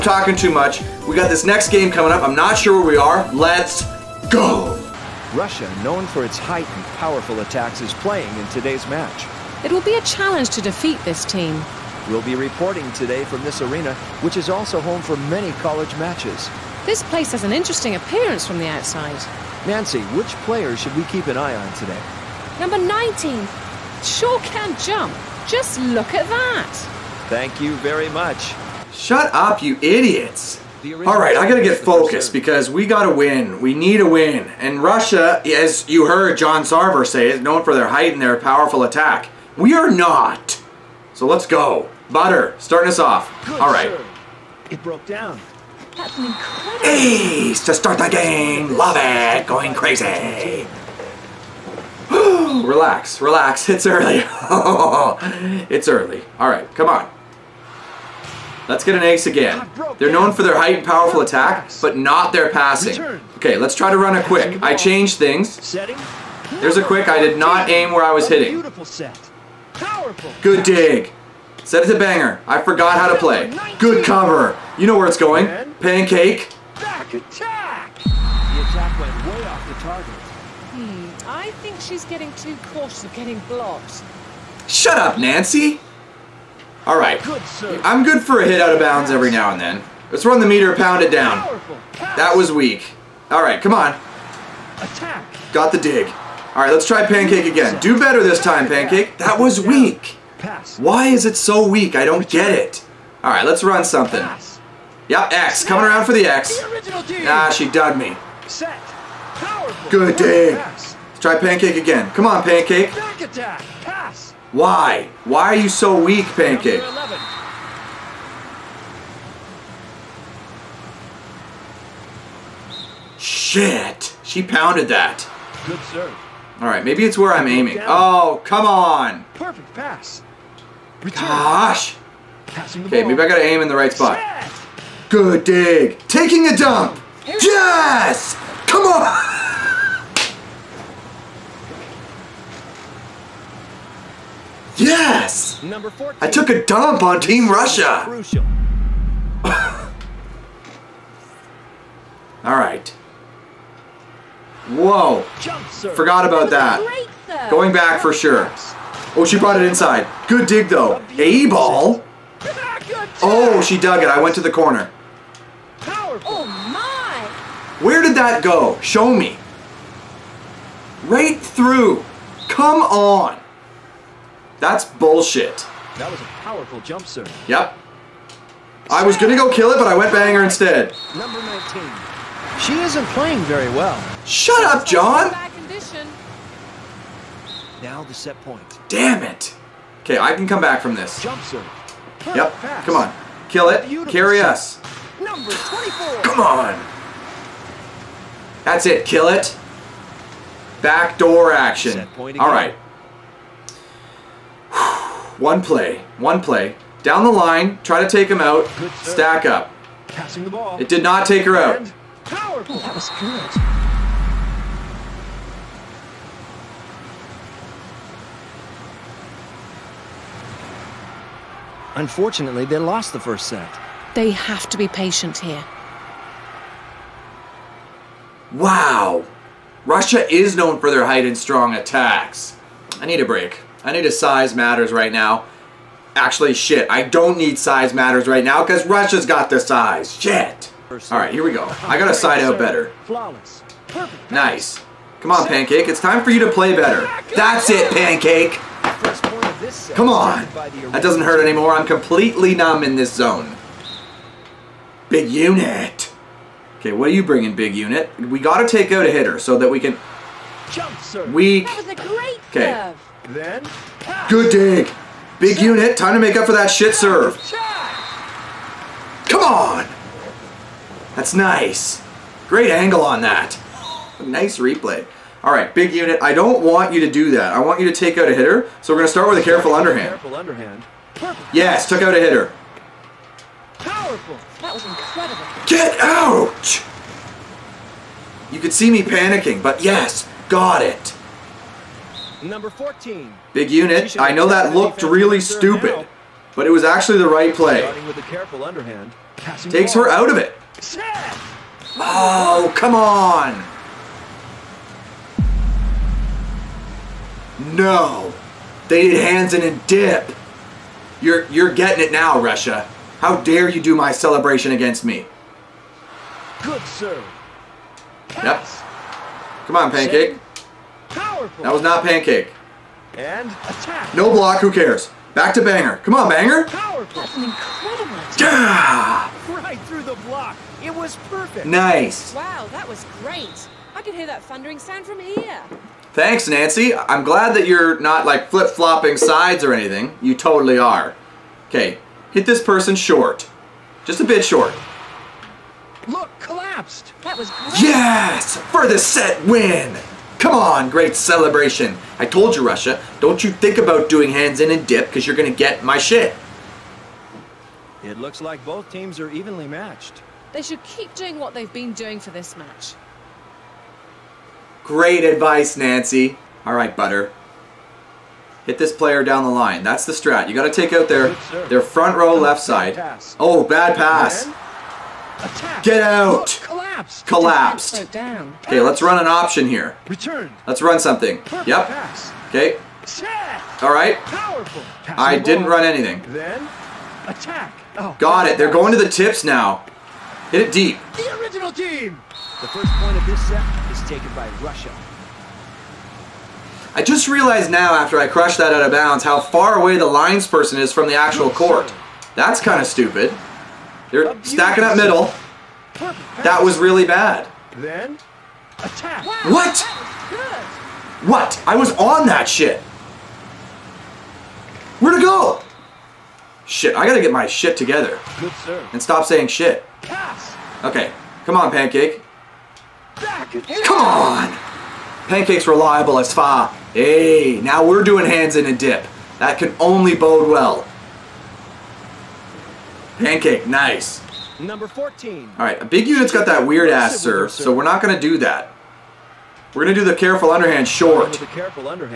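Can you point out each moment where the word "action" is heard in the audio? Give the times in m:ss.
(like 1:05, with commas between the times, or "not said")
3:21.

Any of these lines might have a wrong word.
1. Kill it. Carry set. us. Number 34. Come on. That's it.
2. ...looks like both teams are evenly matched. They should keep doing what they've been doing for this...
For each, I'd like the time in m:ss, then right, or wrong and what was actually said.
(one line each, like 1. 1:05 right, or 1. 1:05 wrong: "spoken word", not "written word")
1. 3:13 wrong: "24", not "34"
2. 5:58 right.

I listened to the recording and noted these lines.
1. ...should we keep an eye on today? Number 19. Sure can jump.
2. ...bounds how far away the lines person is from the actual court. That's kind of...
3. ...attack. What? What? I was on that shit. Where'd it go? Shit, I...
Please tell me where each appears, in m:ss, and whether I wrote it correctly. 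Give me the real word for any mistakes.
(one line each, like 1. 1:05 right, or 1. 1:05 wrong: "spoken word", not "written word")
1. 0:20 right
2. 6:38 right
3. 6:48 right.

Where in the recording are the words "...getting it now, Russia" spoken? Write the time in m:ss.
5:11.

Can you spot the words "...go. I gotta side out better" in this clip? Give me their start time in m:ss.
4:01.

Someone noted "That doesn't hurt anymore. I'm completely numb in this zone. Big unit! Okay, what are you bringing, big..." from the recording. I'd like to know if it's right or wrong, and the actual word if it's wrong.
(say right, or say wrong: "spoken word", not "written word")
right.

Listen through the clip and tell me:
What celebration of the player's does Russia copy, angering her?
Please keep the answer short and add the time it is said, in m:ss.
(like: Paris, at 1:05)
Hands in and dip, at 5:54.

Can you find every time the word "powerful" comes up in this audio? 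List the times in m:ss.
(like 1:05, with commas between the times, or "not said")
0:06, 0:38, 1:00, 2:56, 3:32, 4:43, 5:21, 5:26.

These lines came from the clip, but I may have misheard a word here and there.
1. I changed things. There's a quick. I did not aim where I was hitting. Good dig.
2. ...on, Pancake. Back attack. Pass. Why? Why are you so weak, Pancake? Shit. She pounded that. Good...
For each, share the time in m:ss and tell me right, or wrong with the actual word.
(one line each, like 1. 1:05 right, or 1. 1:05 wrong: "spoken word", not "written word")
1. 1:04 right
2. 1:52 right.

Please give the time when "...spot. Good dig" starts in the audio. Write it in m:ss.
2:13.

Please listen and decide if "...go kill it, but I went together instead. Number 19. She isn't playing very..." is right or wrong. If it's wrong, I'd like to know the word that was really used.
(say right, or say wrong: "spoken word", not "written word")
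wrong: "banger", not "together".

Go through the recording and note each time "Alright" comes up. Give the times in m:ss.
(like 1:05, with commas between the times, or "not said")
4:00, 7:15.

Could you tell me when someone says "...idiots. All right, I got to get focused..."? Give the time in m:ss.
0:29.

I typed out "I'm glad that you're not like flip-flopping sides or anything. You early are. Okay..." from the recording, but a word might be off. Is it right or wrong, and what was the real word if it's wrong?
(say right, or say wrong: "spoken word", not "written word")
wrong: "totally", not "early".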